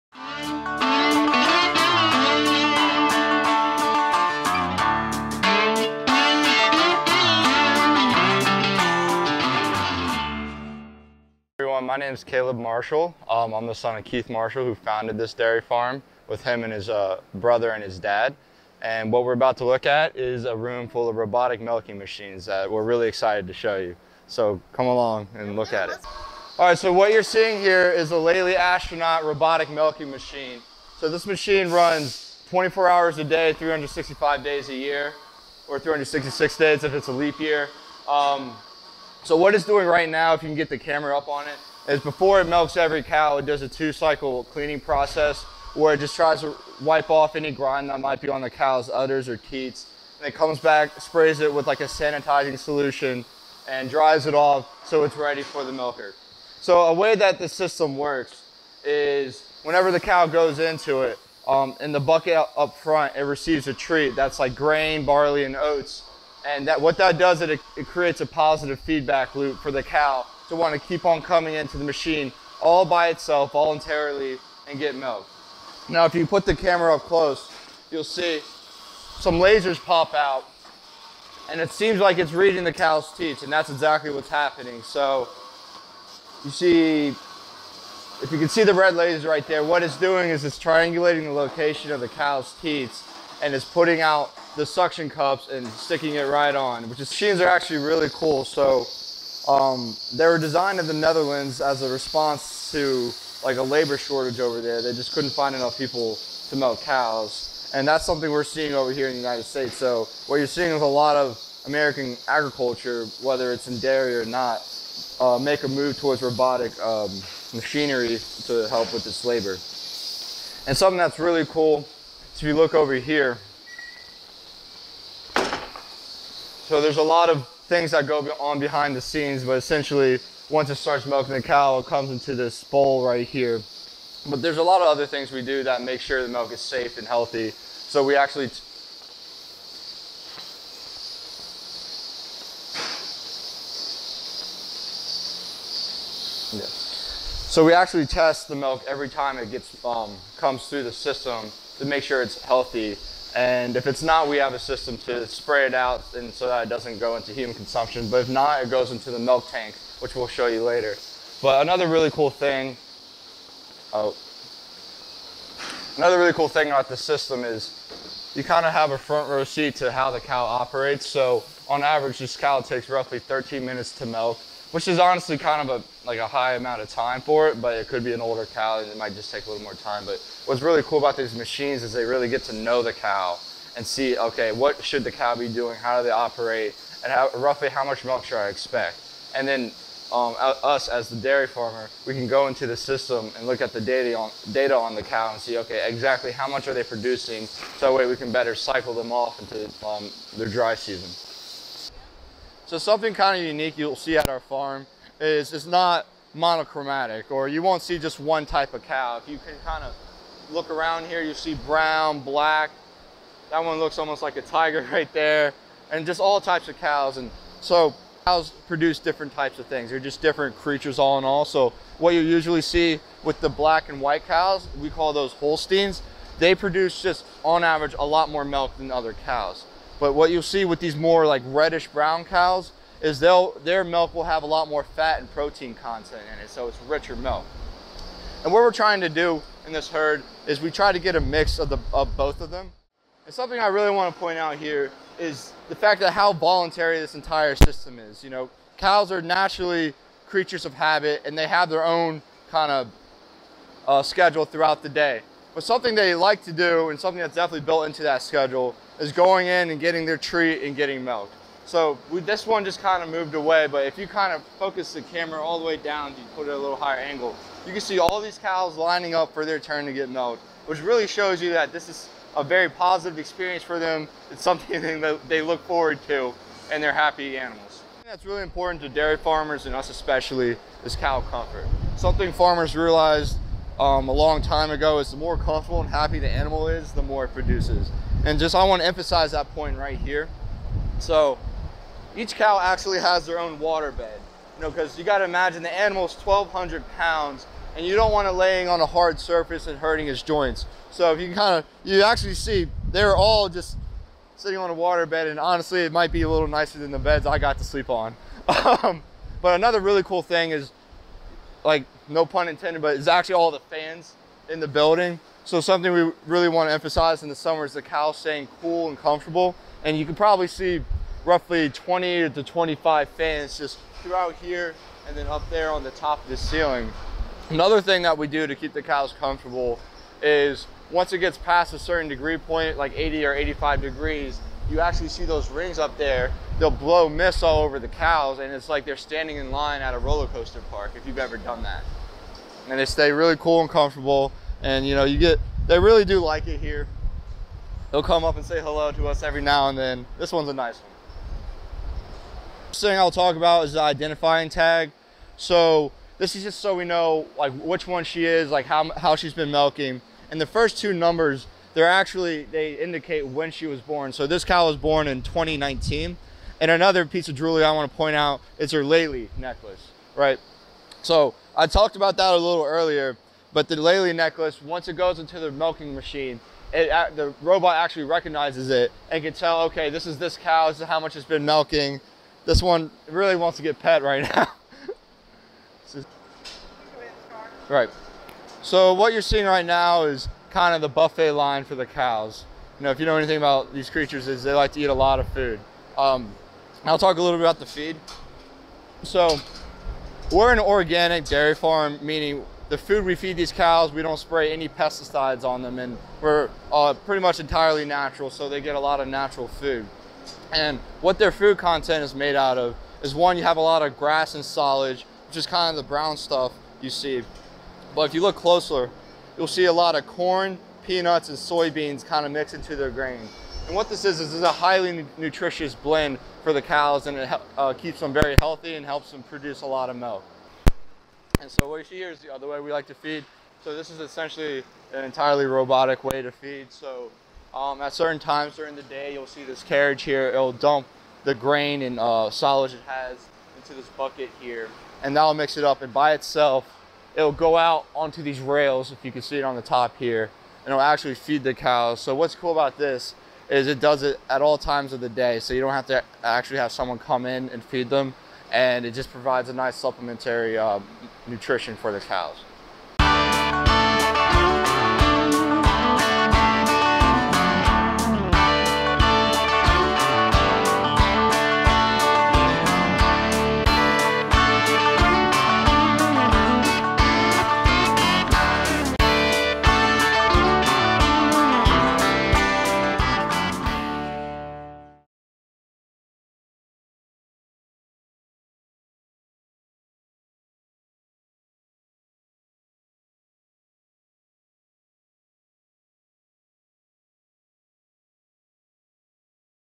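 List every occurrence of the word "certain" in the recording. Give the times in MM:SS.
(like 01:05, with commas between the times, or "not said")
05:31, 07:17.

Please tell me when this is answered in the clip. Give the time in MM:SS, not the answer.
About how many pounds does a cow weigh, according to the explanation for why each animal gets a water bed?
04:56.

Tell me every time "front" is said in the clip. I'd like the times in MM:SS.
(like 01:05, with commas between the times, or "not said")
01:02, 02:48.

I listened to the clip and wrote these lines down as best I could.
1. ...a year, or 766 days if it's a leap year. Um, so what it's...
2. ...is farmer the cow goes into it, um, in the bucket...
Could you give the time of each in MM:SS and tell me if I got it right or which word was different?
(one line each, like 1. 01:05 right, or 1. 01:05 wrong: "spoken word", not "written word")
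1. 00:34 wrong: "366", not "766"
2. 00:58 wrong: "whenever", not "farmer".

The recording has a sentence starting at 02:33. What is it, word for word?
And if it's not, we have a system to spray it out and so that it doesn't go into human consumption.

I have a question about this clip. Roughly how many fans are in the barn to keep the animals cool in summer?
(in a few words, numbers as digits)
20 to 25.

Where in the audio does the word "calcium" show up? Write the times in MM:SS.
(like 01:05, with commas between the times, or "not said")
not said.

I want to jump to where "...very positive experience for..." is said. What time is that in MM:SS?
04:32.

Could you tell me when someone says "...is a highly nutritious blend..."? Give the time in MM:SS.
07:04.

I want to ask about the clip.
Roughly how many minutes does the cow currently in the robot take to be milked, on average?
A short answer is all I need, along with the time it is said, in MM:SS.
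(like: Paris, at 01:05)
13 minutes, at 02:53.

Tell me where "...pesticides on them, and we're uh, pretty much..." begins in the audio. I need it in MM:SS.
06:44.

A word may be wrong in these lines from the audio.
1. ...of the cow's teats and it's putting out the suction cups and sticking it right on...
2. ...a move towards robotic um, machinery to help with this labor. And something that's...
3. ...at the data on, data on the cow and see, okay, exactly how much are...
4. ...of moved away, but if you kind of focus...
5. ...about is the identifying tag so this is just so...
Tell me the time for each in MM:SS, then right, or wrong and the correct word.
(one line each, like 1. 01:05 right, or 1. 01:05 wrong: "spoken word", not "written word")
1. 01:31 right
2. 01:55 right
3. 03:13 right
4. 04:23 right
5. 05:53 right.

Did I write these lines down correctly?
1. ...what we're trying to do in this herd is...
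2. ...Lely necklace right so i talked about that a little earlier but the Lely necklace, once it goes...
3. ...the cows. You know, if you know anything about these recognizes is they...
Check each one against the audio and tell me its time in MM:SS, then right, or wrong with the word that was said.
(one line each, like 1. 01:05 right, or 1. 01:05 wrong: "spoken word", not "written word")
1. 03:58 right
2. 06:08 right
3. 06:31 wrong: "creatures", not "recognizes".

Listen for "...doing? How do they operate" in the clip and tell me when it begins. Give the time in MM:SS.
03:05.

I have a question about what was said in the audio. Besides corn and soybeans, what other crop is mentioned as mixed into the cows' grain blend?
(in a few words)
peanuts.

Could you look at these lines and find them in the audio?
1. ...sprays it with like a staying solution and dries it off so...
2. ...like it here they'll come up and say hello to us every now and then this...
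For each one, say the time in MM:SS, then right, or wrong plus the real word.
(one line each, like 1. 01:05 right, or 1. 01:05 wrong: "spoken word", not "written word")
1. 00:51 wrong: "sanitizing", not "staying"
2. 05:46 right.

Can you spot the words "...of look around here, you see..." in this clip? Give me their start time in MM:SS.
03:29.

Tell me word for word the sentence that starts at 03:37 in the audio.
And so cows produce different types of things.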